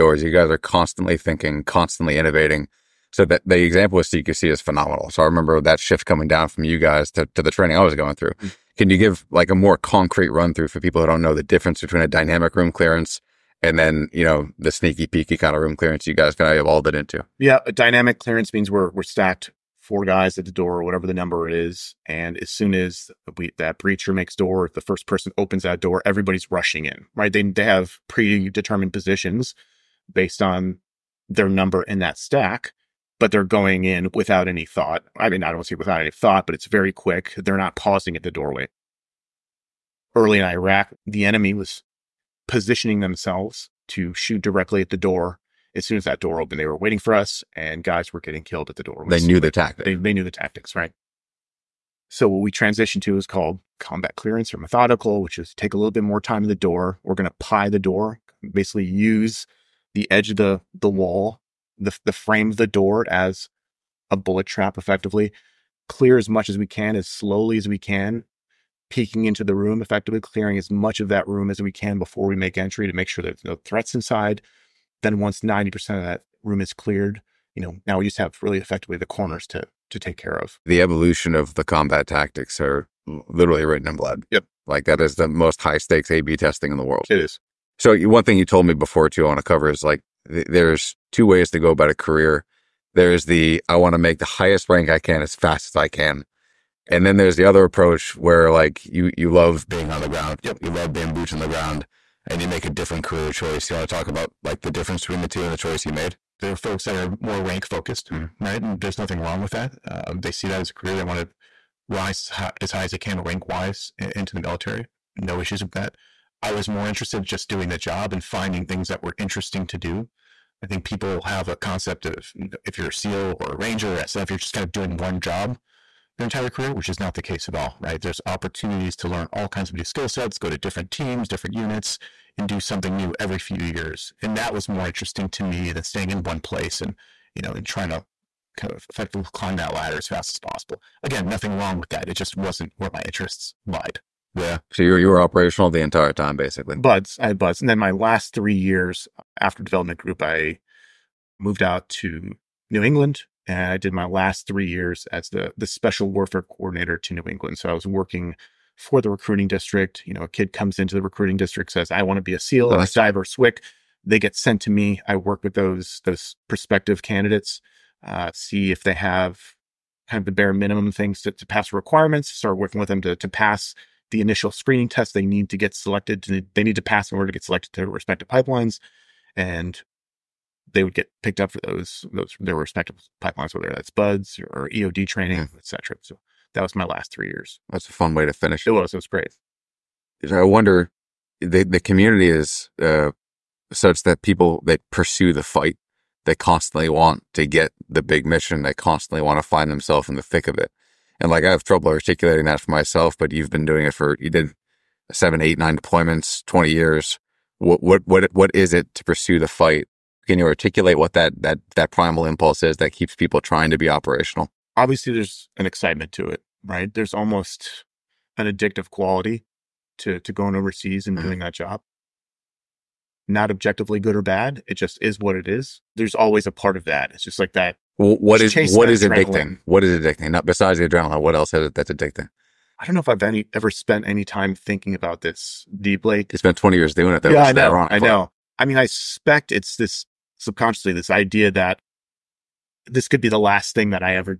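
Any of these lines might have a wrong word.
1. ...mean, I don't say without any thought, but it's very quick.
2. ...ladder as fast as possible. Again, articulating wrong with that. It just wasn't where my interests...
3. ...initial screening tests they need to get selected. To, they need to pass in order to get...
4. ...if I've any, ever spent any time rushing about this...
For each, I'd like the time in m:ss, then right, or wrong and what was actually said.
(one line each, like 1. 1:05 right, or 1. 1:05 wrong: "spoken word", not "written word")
1. 0:35 right
2. 2:19 wrong: "nothing", not "articulating"
3. 2:54 right
4. 3:53 wrong: "thinking", not "rushing".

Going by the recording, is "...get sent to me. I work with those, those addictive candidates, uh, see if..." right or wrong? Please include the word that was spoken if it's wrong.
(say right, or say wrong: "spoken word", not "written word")
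wrong: "prospective", not "addictive".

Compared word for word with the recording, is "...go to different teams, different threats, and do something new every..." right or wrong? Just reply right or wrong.
wrong.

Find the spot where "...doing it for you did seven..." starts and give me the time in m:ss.
3:23.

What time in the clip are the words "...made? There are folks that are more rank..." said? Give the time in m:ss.
1:45.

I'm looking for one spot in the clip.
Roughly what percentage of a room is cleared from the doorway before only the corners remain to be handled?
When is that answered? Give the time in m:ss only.
1:15.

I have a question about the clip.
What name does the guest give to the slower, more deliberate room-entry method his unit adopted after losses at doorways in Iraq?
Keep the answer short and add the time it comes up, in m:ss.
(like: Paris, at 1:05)
combat clearance, at 0:53.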